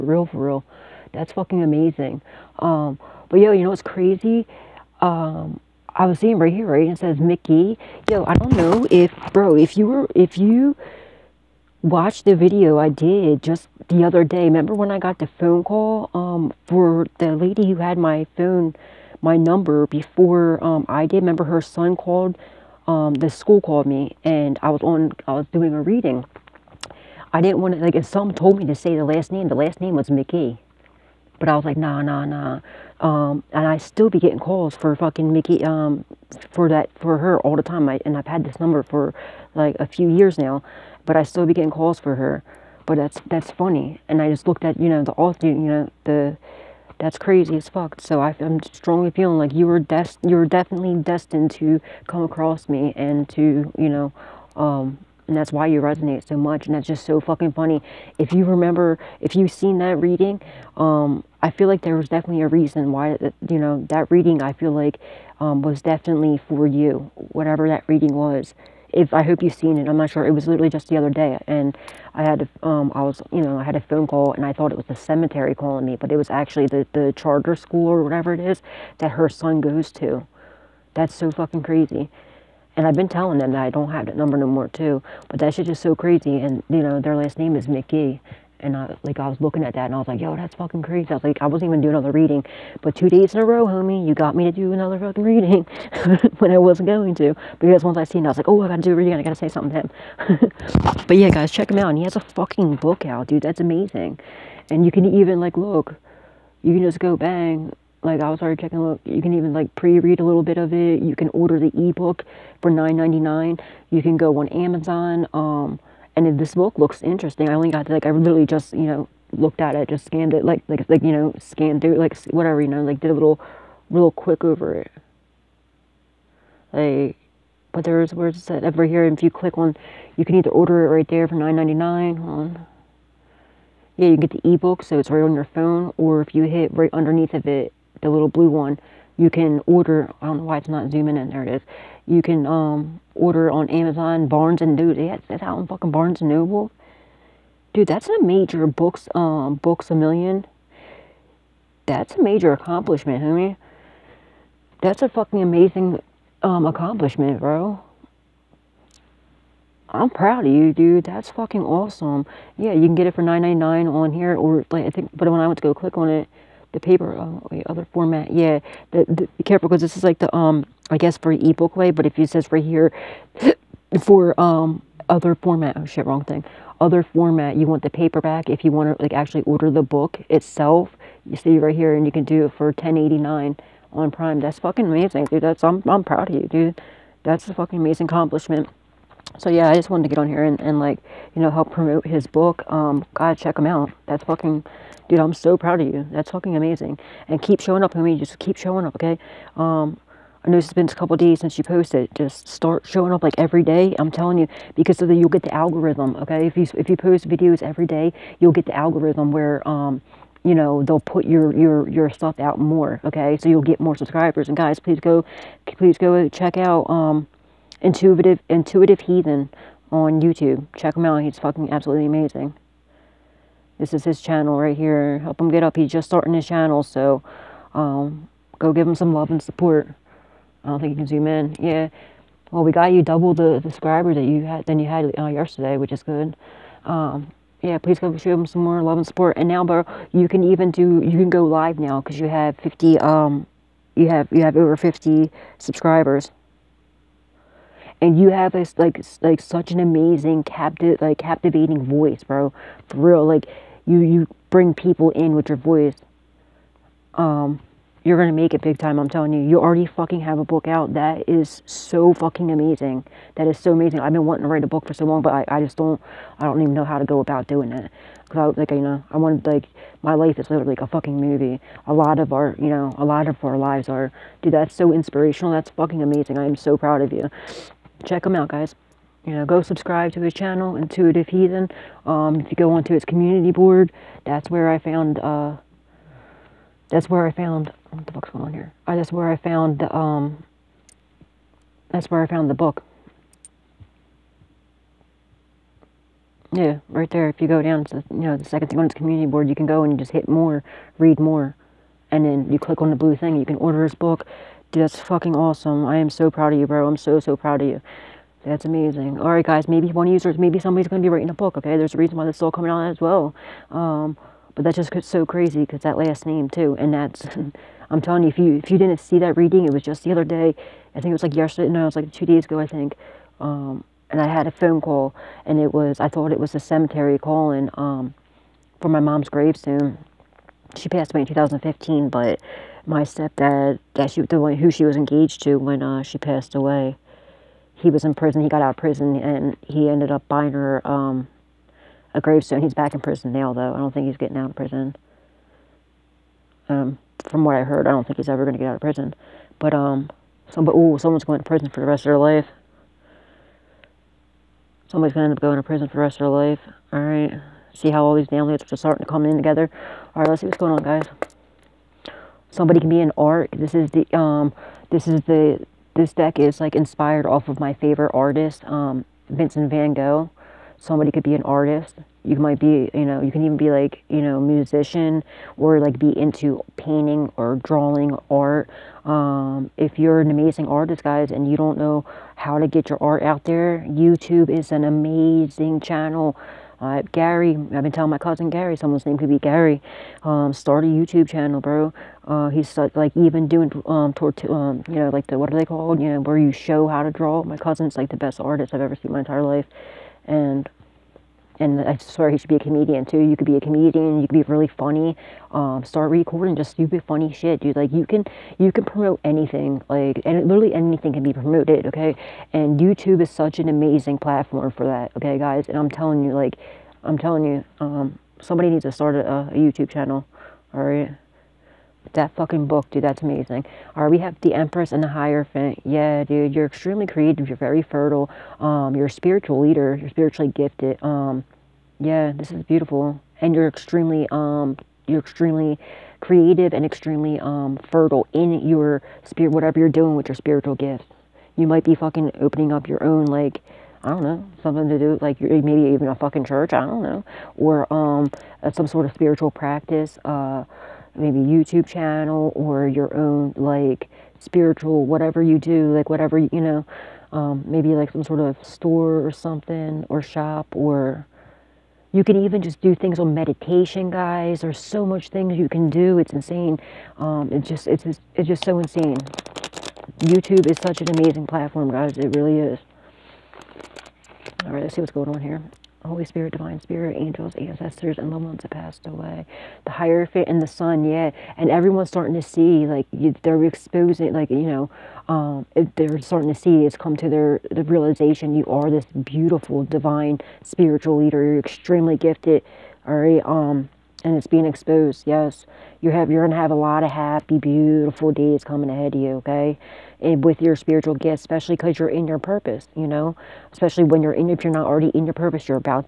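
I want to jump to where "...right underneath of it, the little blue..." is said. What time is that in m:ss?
2:16.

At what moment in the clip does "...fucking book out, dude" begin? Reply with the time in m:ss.
1:42.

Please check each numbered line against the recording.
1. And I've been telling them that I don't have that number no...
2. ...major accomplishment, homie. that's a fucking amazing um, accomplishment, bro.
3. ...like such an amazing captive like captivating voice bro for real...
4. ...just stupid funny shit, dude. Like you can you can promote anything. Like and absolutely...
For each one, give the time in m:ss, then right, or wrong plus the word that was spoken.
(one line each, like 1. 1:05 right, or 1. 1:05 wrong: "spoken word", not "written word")
1. 1:22 right
2. 2:32 right
3. 4:09 right
4. 6:46 wrong: "literally", not "absolutely".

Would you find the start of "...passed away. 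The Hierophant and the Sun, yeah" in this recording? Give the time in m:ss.
7:58.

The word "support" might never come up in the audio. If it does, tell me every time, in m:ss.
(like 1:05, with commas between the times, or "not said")
3:49, 3:59.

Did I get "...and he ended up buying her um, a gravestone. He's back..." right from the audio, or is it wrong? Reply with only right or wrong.
right.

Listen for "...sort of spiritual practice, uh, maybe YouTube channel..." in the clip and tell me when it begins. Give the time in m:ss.
7:28.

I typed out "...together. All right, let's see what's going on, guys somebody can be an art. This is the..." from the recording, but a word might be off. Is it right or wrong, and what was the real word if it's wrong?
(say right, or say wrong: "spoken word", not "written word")
right.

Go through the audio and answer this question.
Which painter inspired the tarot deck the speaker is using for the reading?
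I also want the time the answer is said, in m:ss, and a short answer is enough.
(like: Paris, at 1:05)
Vincent Van Gogh, at 6:09.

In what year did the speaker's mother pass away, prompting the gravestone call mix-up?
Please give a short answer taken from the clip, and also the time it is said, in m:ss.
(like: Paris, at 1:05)
2015, at 5:31.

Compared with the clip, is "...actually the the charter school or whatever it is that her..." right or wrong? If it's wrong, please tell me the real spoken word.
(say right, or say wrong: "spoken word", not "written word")
right.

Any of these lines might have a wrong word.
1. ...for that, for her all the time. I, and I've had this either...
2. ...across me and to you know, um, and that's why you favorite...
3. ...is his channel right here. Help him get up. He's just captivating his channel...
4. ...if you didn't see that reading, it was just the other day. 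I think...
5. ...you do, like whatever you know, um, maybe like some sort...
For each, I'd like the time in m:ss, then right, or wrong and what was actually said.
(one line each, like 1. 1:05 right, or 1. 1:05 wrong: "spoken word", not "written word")
1. 0:36 wrong: "number", not "either"
2. 0:52 wrong: "resonate", not "favorite"
3. 3:43 wrong: "starting", not "captivating"
4. 5:18 right
5. 7:35 right.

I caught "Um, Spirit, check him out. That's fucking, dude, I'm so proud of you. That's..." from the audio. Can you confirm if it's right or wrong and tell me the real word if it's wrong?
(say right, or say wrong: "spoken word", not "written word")
wrong: "God", not "Spirit".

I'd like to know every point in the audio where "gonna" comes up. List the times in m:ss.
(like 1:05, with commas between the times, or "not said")
4:18, 8:16.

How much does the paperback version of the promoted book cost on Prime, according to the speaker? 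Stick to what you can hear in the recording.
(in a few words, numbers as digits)
$10.89.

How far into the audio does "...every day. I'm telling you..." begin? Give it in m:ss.
3:23.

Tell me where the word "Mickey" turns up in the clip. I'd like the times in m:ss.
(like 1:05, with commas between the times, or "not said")
0:07, 0:30, 0:35, 1:27.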